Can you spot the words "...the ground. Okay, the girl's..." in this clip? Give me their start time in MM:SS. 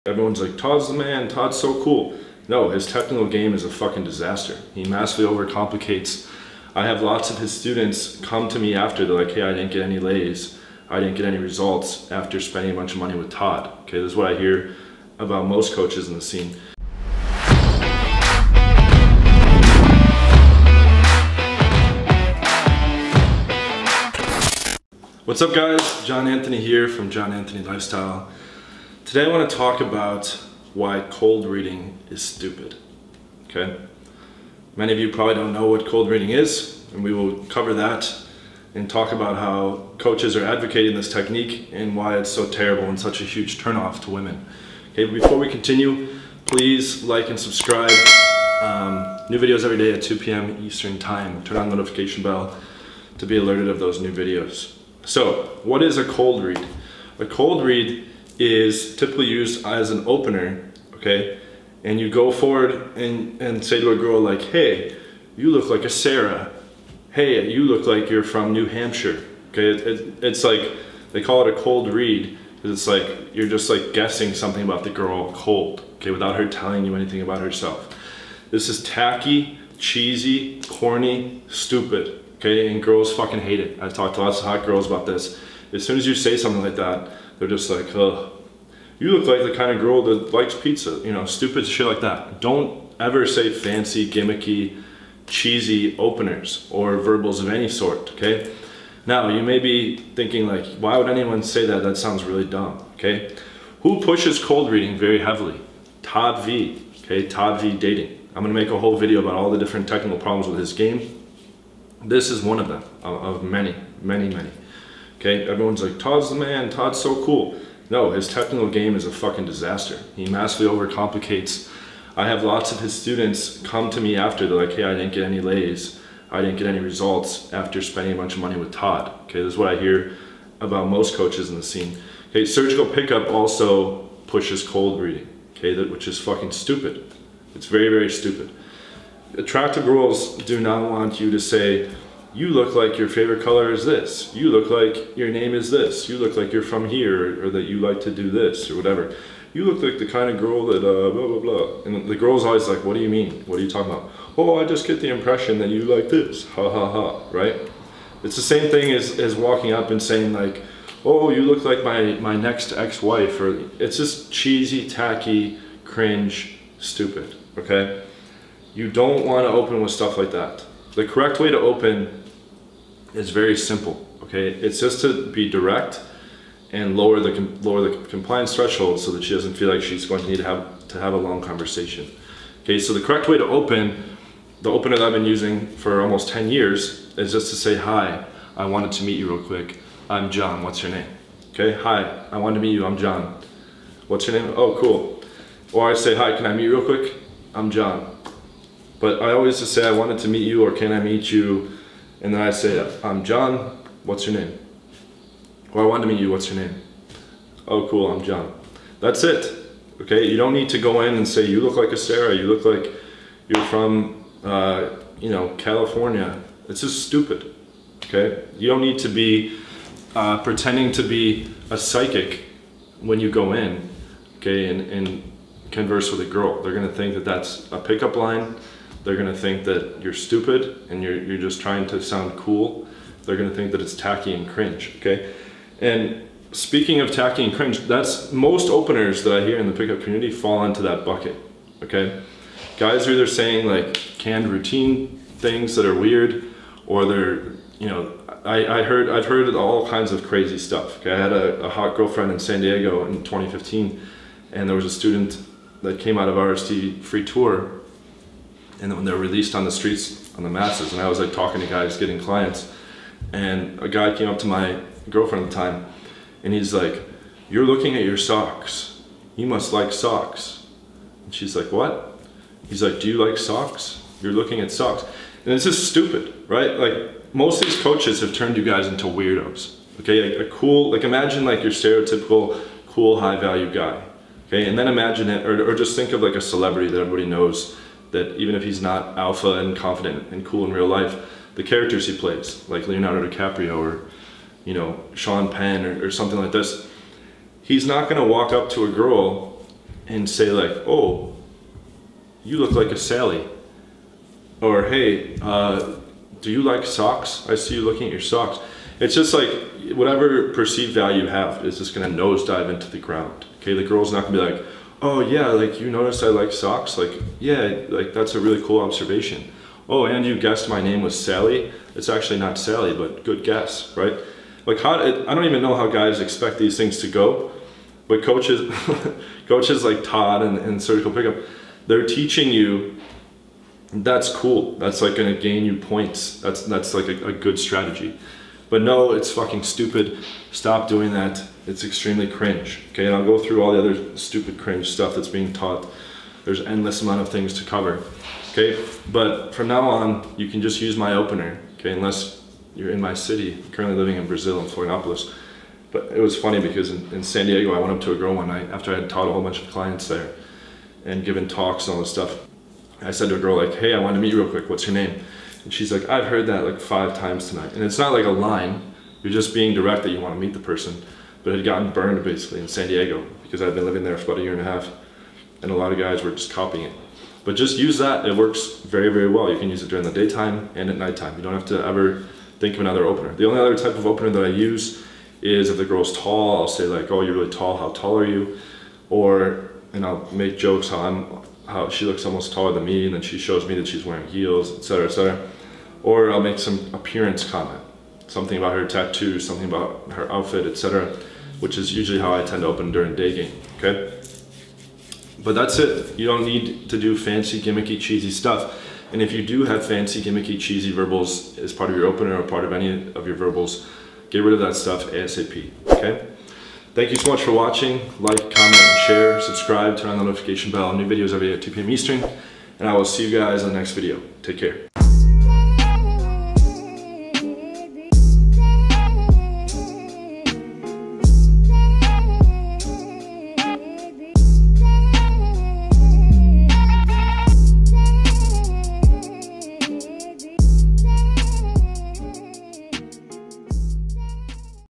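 05:12.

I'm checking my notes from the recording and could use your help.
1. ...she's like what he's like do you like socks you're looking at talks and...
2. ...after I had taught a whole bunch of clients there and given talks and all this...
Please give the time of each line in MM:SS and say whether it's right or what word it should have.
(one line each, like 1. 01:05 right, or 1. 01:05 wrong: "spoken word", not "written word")
1. 04:31 wrong: "socks", not "talks"
2. 05:58 right.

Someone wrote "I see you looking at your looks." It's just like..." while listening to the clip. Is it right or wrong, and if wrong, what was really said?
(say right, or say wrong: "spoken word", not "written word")
wrong: "socks", not "looks".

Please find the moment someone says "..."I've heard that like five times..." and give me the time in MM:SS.
06:06.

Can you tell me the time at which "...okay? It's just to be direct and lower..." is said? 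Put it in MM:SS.
02:54.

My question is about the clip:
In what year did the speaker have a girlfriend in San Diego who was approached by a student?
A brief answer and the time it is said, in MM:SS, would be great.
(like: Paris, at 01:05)
2015, at 04:13.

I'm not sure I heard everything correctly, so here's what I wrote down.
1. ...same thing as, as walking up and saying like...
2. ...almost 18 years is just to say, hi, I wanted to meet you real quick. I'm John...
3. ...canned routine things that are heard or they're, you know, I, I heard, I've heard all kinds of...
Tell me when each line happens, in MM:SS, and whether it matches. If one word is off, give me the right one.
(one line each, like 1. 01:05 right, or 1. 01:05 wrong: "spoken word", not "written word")
1. 02:38 right
2. 03:06 wrong: "10", not "18"
3. 04:03 wrong: "weird", not "heard".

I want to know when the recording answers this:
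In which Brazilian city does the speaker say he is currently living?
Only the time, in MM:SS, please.
05:54.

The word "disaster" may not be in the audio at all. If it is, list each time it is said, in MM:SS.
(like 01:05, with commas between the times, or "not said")
00:04, 01:59.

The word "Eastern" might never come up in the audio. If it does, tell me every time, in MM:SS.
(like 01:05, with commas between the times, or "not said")
00:50, 07:01.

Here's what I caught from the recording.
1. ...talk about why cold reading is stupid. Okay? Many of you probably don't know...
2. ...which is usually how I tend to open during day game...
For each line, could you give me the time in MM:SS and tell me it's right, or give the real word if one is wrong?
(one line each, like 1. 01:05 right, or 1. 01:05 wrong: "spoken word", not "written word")
1. 00:29 right
2. 06:41 right.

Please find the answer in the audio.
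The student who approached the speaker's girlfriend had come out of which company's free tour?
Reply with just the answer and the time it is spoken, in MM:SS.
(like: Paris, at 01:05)
RSD, at 04:16.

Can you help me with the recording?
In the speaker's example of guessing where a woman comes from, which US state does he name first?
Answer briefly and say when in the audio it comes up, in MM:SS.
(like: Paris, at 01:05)
New Hampshire, at 01:08.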